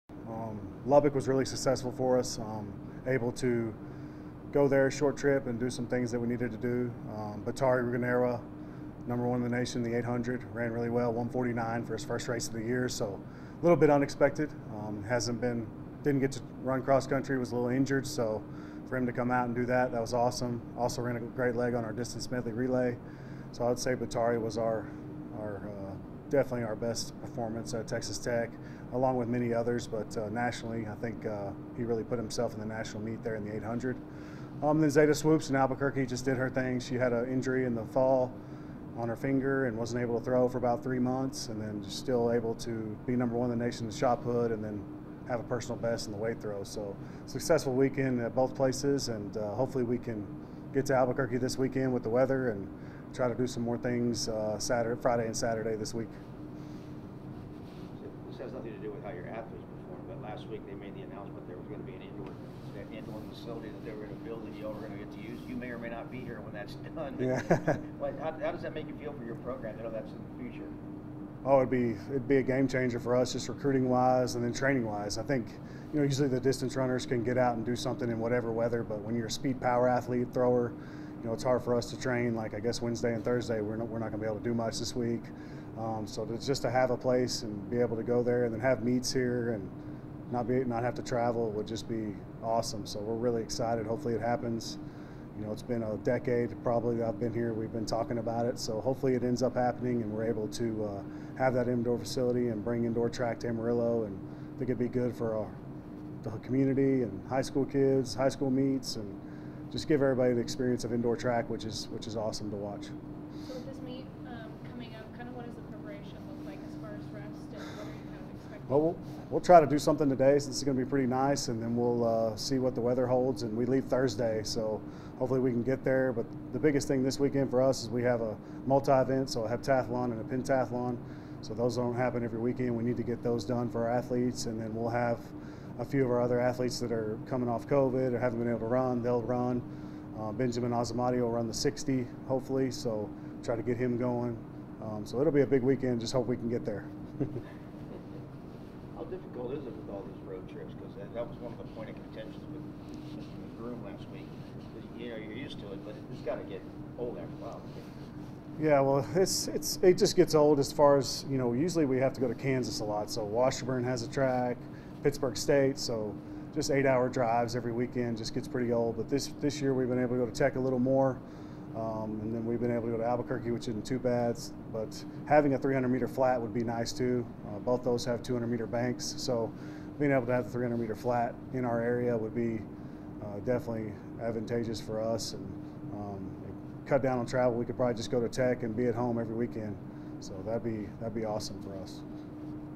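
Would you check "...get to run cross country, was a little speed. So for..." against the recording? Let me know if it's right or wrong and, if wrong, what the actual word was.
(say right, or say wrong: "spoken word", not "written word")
wrong: "injured", not "speed".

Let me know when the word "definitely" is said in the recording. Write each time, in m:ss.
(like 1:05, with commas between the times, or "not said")
0:26, 3:03.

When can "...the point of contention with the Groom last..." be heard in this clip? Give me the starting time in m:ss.
2:31.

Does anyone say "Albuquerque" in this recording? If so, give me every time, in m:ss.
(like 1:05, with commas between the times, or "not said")
0:35, 0:50, 2:53.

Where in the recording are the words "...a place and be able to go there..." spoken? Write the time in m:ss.
1:26.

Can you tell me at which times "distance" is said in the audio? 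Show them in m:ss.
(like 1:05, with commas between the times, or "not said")
0:21, 1:16.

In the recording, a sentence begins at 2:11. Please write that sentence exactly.
So those don't happen every weekend.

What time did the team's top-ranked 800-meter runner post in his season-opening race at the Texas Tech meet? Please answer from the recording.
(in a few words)
1:49.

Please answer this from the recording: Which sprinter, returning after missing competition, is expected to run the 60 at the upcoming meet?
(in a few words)
Benjamin Azamati.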